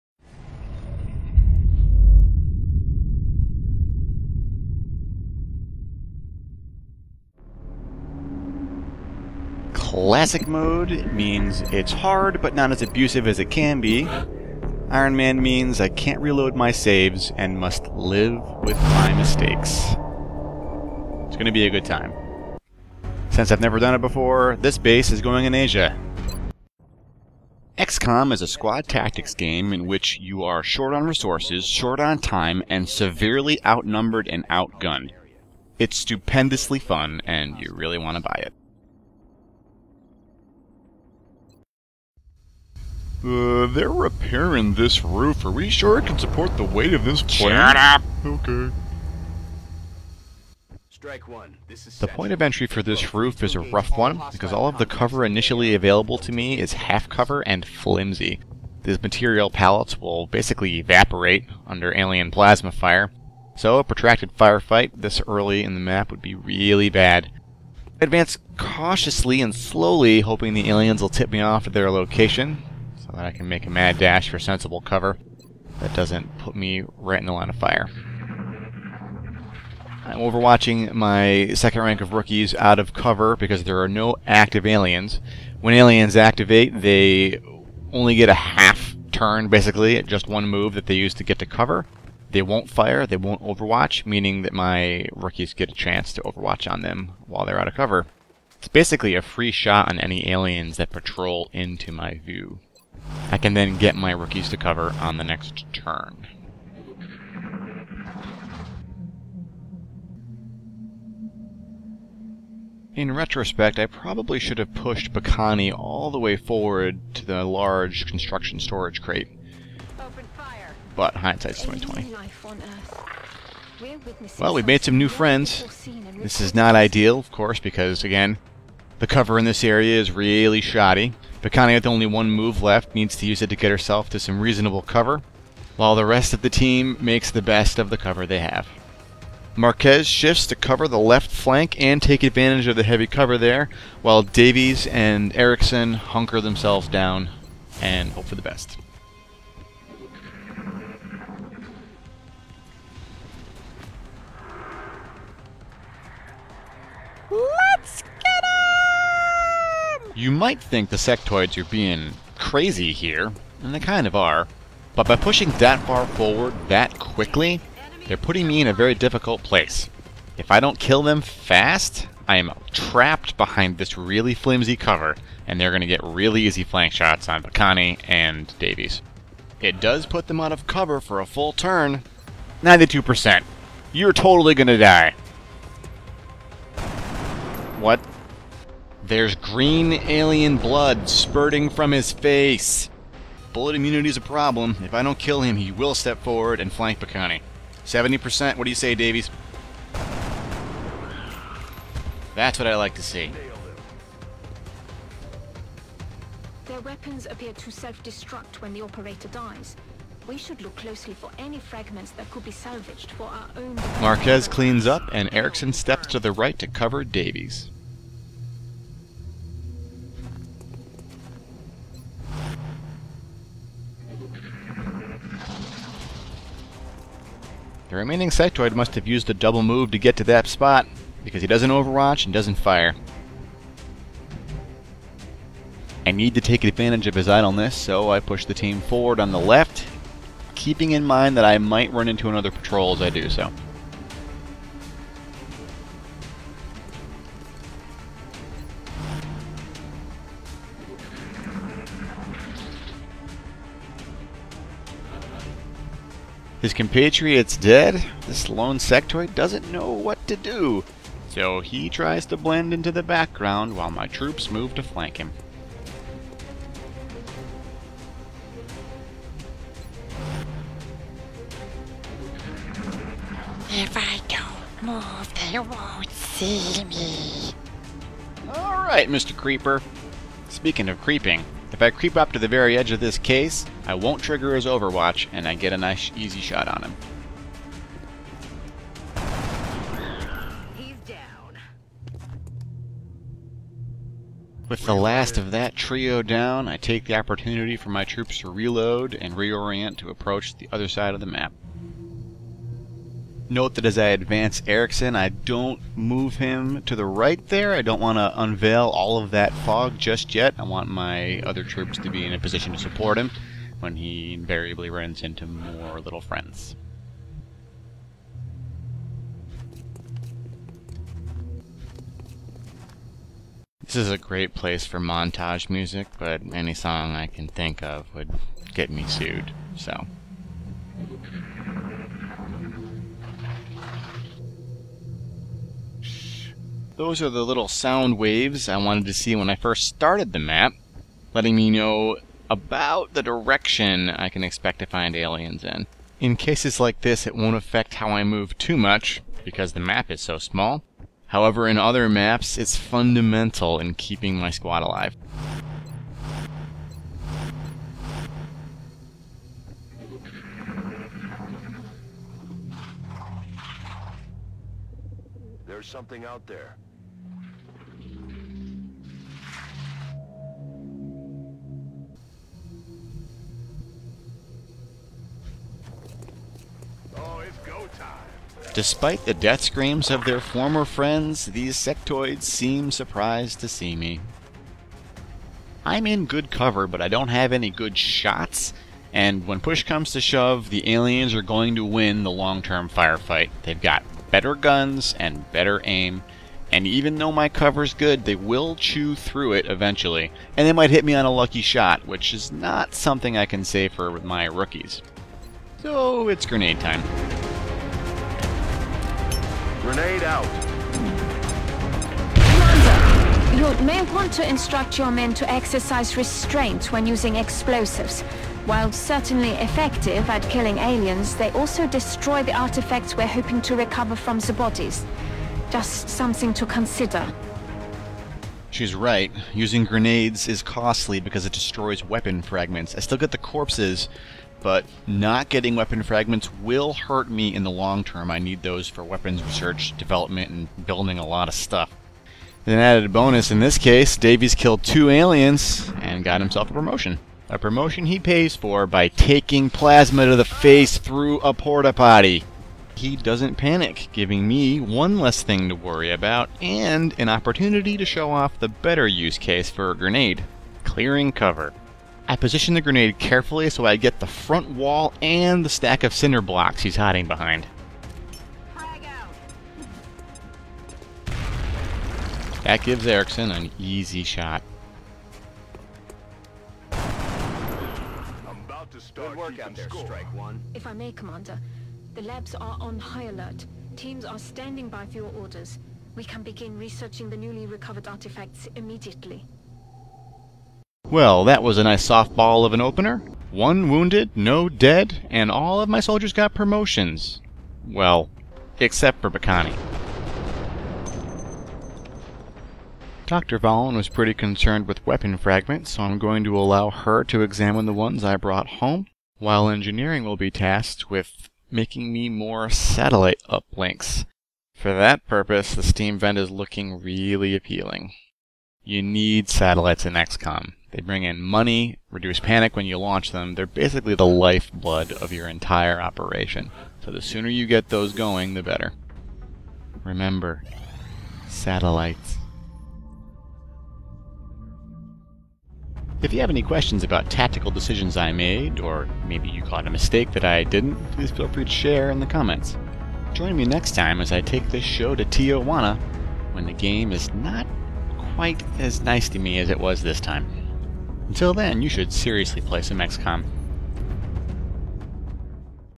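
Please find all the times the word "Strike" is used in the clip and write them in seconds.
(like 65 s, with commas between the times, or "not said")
50 s, 480 s.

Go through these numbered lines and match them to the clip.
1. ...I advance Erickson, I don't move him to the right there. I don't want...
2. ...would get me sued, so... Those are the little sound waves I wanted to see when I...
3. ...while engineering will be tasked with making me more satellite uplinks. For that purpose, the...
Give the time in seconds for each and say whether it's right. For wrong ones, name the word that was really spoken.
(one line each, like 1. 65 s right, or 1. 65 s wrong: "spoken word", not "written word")
1. 303 s right
2. 328 s right
3. 509 s right.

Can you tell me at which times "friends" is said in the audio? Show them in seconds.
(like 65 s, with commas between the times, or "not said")
125 s, 316 s, 380 s.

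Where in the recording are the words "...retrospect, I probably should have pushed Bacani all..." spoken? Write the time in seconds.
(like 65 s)
113 s.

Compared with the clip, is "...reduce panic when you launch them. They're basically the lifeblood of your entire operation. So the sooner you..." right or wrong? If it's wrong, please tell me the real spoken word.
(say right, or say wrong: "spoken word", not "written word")
right.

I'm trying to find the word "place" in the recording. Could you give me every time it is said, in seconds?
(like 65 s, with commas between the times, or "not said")
169 s, 324 s.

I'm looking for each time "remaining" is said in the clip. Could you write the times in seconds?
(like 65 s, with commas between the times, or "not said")
227 s.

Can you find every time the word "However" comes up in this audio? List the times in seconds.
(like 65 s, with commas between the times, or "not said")
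351 s.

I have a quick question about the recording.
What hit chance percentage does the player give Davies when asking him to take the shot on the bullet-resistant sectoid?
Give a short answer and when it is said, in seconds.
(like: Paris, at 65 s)
70%, at 197 s.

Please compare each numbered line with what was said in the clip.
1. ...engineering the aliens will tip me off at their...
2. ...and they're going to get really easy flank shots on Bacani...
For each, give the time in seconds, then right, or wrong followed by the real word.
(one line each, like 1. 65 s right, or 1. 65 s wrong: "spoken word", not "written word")
1. 70 s wrong: "hoping", not "engineering"
2. 175 s right.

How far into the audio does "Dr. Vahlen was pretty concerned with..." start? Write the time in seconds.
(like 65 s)
503 s.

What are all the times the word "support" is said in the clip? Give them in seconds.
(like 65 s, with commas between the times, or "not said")
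46 s, 312 s.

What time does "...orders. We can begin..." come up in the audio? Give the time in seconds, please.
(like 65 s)
485 s.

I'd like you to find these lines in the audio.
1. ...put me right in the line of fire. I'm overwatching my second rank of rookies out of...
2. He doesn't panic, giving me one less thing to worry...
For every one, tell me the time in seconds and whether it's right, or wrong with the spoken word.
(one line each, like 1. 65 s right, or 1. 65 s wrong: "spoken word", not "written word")
1. 76 s right
2. 452 s right.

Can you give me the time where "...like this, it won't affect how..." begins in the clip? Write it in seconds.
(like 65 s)
346 s.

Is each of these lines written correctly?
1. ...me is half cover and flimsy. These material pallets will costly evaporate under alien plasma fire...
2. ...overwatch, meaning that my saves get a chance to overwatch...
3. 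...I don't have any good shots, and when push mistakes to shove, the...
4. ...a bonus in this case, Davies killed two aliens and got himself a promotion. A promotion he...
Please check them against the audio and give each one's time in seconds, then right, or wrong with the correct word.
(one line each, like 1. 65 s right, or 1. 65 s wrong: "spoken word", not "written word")
1. 56 s wrong: "basically", not "costly"
2. 93 s wrong: "rookies", not "saves"
3. 387 s wrong: "comes", not "mistakes"
4. 443 s right.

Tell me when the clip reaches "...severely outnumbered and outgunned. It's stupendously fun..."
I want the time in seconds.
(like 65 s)
32 s.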